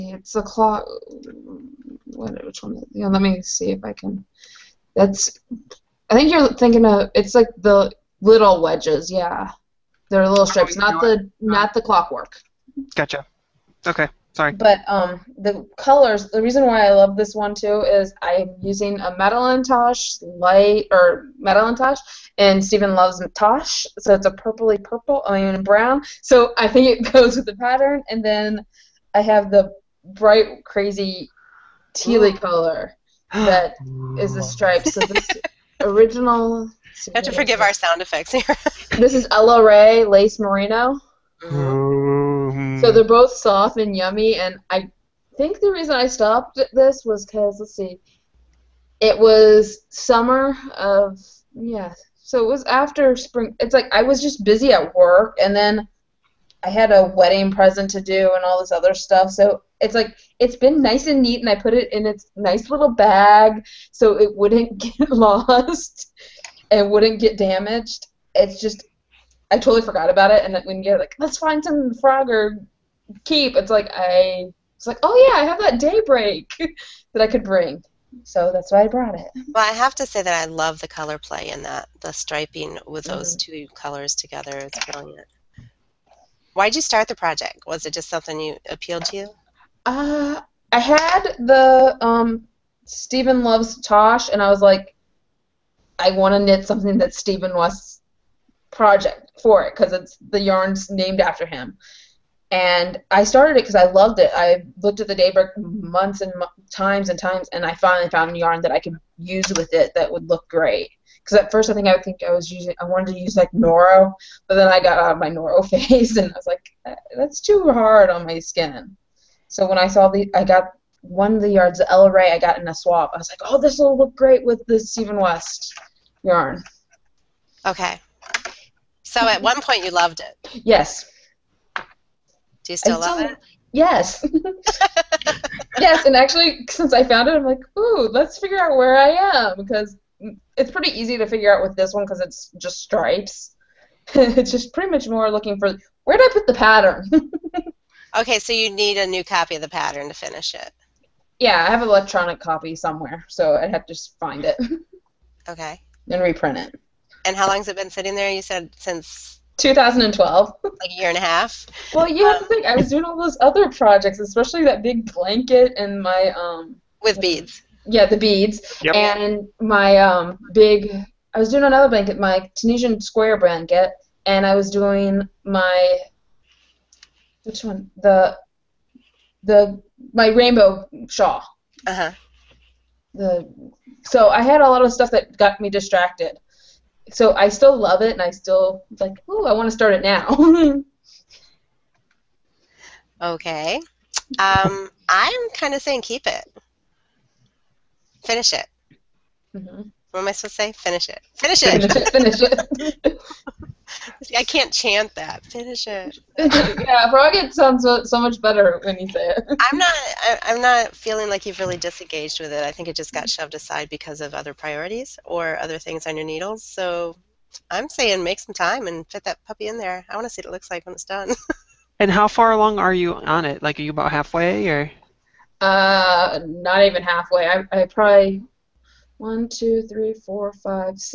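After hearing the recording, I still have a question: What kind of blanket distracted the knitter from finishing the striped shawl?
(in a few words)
Tunisian square blanket.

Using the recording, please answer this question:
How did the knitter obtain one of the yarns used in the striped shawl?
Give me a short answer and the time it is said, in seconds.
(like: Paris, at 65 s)
In a swap, at 122 s.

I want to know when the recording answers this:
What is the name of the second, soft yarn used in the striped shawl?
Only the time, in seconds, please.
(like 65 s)
39 s.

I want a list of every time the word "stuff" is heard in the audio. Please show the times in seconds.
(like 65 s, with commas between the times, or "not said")
58 s, 184 s.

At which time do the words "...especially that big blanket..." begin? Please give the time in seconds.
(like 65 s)
164 s.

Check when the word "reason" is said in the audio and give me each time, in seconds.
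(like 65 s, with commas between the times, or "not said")
16 s, 45 s.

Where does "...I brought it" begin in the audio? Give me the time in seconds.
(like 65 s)
78 s.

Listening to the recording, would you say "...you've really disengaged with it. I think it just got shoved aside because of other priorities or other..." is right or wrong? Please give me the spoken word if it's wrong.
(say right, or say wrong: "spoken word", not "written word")
right.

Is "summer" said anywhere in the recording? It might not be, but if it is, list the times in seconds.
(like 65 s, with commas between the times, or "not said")
49 s.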